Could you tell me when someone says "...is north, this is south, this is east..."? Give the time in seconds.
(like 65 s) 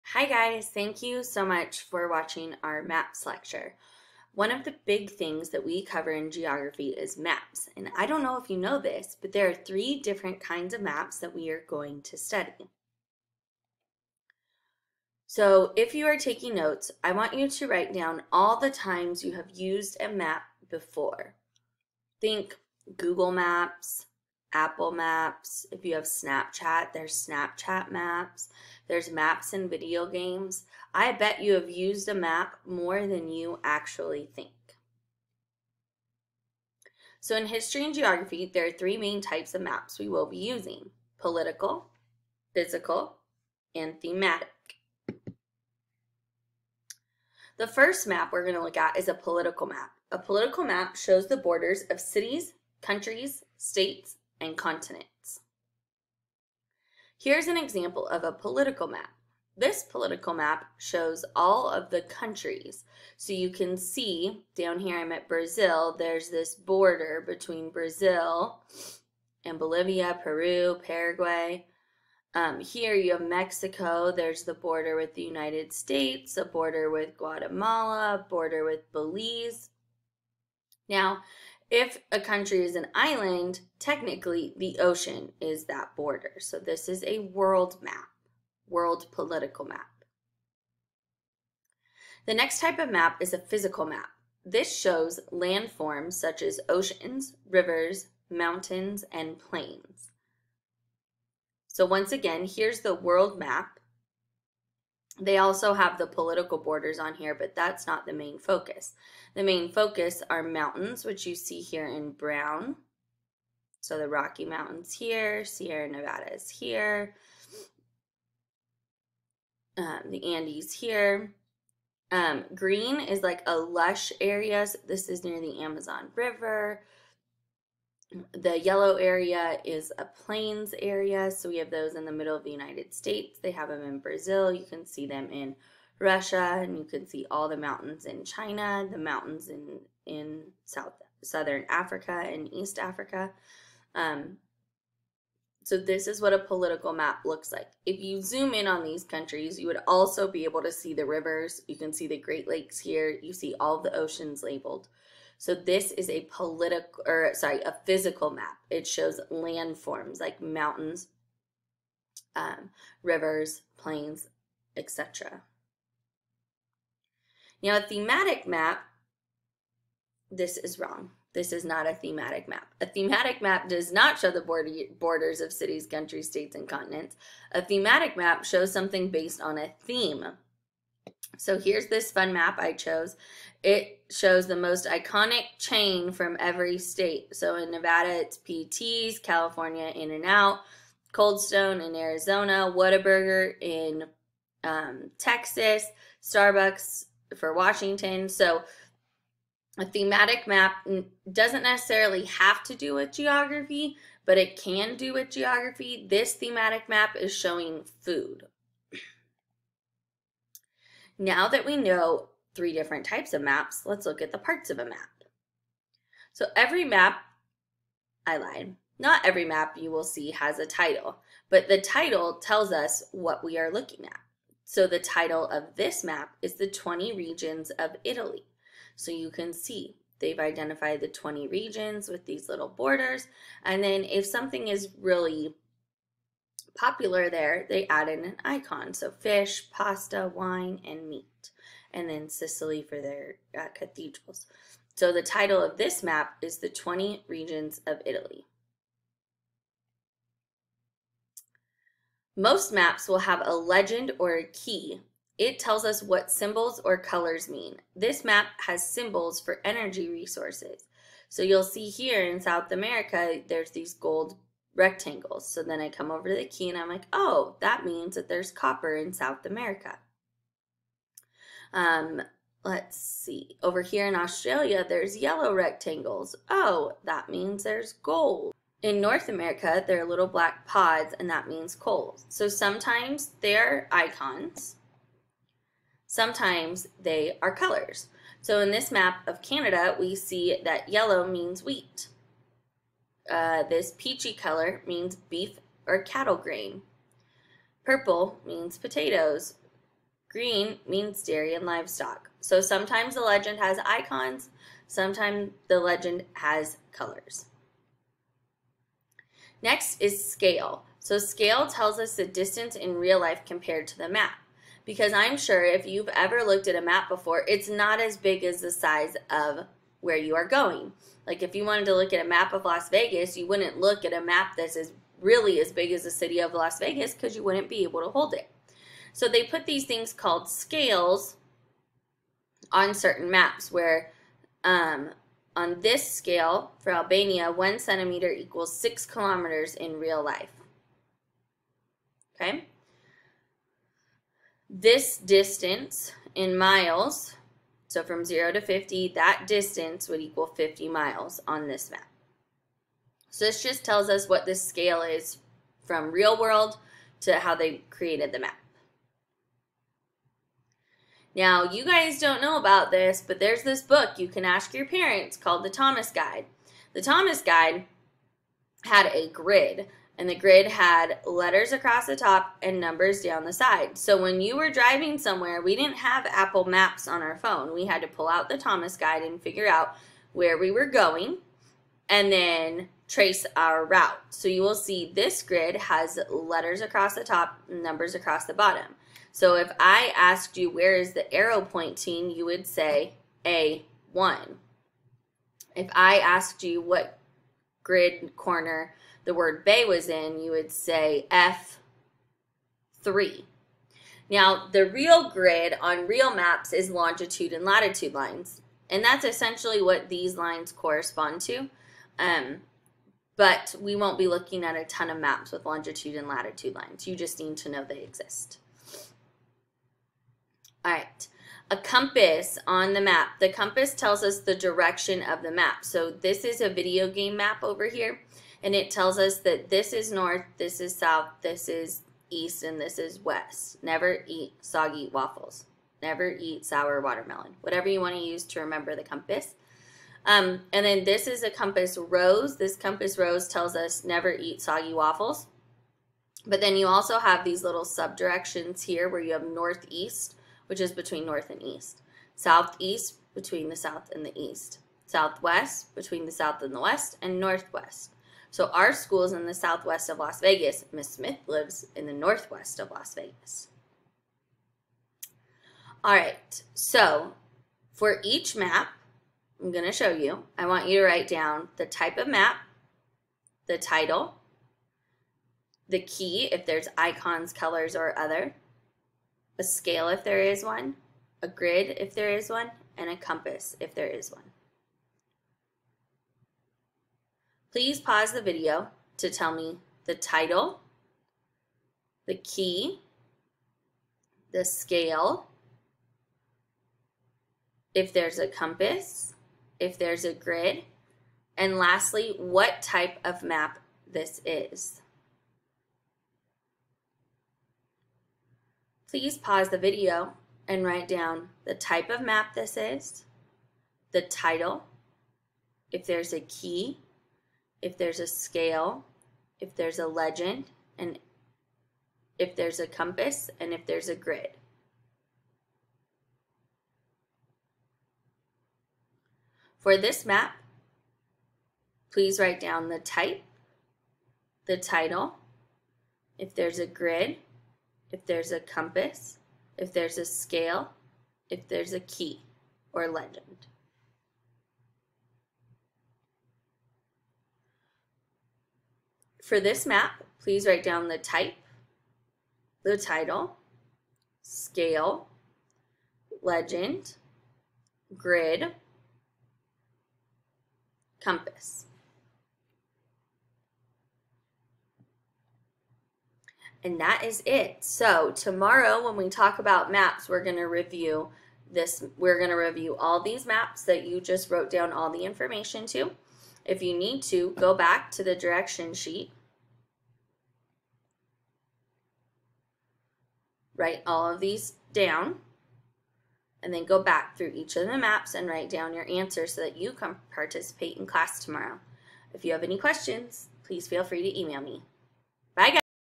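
429 s.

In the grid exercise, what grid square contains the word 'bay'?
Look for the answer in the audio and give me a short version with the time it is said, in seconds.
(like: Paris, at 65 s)
F3, at 403 s.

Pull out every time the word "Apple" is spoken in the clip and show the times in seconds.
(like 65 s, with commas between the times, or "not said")
24 s, 376 s.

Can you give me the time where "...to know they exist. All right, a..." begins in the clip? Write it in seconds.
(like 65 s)
417 s.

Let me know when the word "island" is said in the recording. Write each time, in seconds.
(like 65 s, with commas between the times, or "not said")
82 s.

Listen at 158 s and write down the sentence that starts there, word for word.
It shows landforms like mountains, um, rivers, plains, etc.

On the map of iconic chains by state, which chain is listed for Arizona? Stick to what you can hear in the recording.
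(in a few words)
Cold Stone.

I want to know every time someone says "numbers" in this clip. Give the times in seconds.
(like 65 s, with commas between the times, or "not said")
372 s, 387 s.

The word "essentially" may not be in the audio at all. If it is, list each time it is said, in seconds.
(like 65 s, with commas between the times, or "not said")
409 s.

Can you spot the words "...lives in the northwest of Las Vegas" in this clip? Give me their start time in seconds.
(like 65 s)
461 s.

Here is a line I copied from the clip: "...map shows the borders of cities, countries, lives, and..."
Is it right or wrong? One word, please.
wrong.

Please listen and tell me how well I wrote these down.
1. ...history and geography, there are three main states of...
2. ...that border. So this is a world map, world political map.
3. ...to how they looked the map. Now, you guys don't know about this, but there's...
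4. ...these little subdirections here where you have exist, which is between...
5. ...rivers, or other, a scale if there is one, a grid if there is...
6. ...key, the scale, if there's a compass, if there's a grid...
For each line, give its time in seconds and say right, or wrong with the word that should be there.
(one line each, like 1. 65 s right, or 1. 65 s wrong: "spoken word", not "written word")
1. 37 s wrong: "types", not "states"
2. 85 s right
3. 357 s wrong: "created", not "looked"
4. 447 s wrong: "northeast", not "exist"
5. 477 s wrong: "colors", not "rivers"
6. 492 s right.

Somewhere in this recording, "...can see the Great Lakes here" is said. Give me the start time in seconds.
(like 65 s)
151 s.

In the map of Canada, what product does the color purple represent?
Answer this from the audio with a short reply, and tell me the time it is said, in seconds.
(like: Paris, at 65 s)
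Potatoes, at 298 s.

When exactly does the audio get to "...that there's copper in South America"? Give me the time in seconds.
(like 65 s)
268 s.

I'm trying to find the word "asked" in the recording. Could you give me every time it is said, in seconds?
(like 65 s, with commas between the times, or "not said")
390 s, 396 s.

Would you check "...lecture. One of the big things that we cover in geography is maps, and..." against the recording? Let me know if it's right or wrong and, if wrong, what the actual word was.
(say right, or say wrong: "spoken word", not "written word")
right.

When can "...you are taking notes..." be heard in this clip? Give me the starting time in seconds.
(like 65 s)
15 s.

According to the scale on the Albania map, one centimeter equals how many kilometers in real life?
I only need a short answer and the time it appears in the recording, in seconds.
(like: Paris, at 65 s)
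6 kilometers, at 338 s.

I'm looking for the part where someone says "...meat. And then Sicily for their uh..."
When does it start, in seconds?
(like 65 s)
241 s.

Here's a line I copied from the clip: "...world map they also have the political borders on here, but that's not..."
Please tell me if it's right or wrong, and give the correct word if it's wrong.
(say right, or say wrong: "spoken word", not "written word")
right.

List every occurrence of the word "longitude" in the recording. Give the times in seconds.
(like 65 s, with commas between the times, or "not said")
406 s, 415 s.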